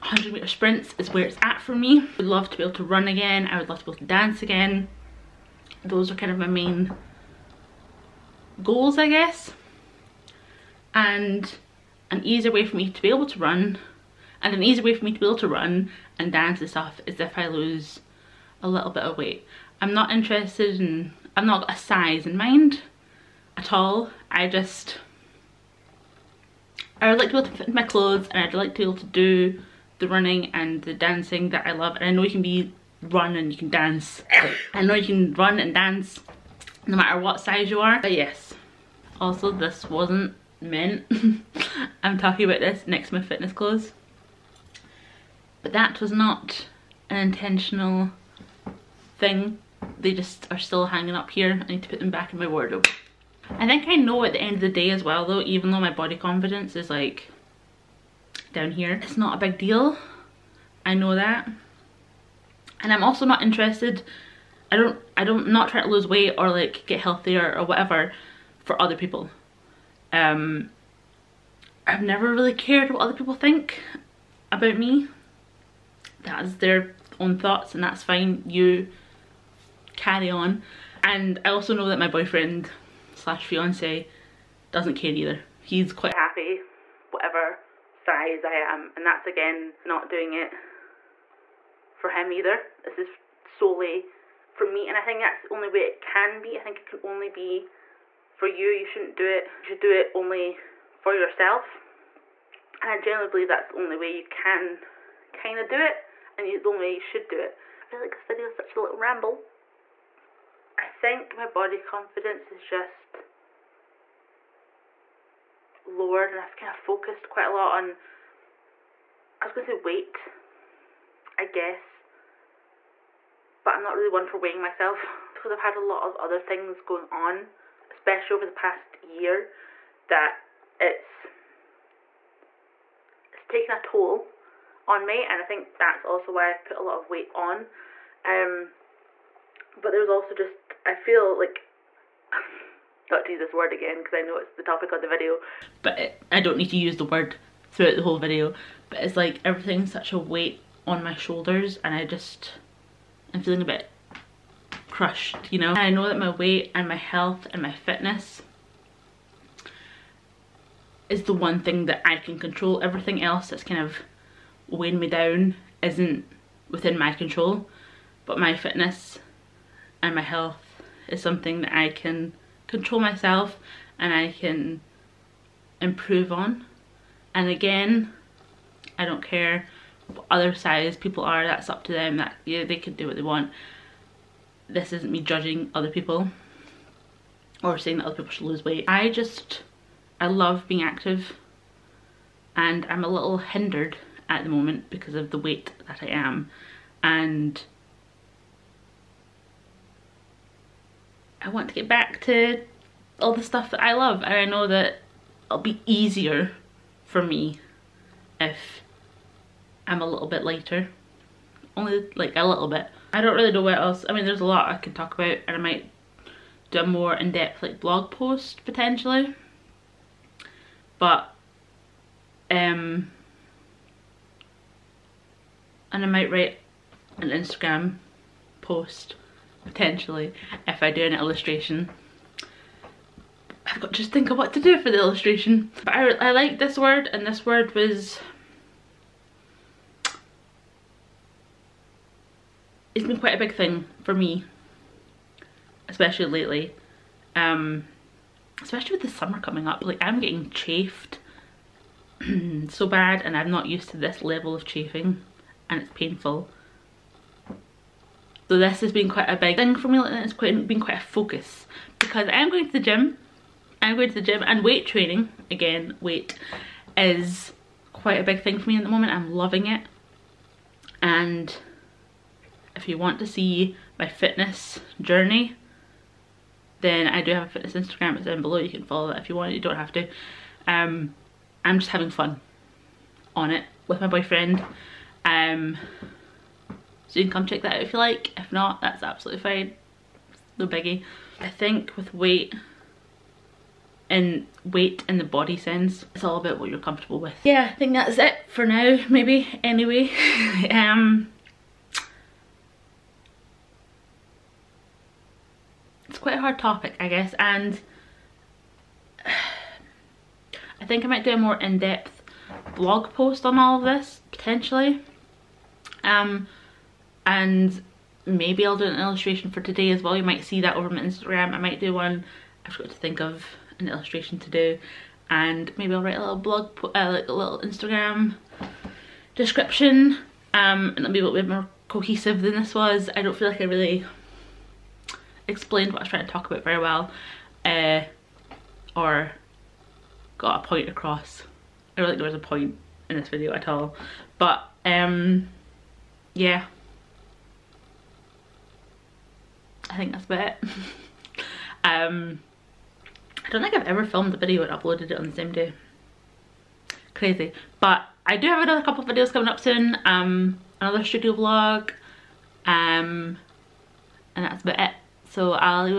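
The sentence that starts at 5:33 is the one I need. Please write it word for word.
I don't feel like I really explained what I was trying to talk about very well uh, or got a point across.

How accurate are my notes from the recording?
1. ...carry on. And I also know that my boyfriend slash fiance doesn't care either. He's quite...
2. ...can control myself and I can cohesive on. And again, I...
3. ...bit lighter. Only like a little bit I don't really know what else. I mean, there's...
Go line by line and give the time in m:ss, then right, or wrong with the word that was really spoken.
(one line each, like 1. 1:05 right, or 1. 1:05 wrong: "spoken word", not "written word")
1. 1:19 right
2. 2:51 wrong: "improve", not "cohesive"
3. 3:30 right.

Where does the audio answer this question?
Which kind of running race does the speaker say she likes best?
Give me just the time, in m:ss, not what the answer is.
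0:00.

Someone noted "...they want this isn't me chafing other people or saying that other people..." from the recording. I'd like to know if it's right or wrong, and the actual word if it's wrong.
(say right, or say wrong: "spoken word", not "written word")
wrong: "judging", not "chafing".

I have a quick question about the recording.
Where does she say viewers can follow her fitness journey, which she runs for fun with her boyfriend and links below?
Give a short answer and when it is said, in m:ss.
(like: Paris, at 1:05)
fitness Instagram, at 4:37.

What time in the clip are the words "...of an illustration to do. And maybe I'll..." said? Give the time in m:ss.
5:23.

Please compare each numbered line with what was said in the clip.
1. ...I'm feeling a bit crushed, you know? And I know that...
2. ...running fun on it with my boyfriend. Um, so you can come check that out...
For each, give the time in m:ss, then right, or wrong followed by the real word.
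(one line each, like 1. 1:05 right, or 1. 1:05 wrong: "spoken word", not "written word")
1. 2:33 right
2. 4:41 wrong: "having", not "running".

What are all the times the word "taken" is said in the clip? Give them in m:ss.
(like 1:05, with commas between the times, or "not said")
2:13.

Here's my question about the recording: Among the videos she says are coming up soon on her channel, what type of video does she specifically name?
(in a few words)
studio vlog.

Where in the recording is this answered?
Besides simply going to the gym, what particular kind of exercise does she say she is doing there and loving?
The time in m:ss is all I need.
4:24.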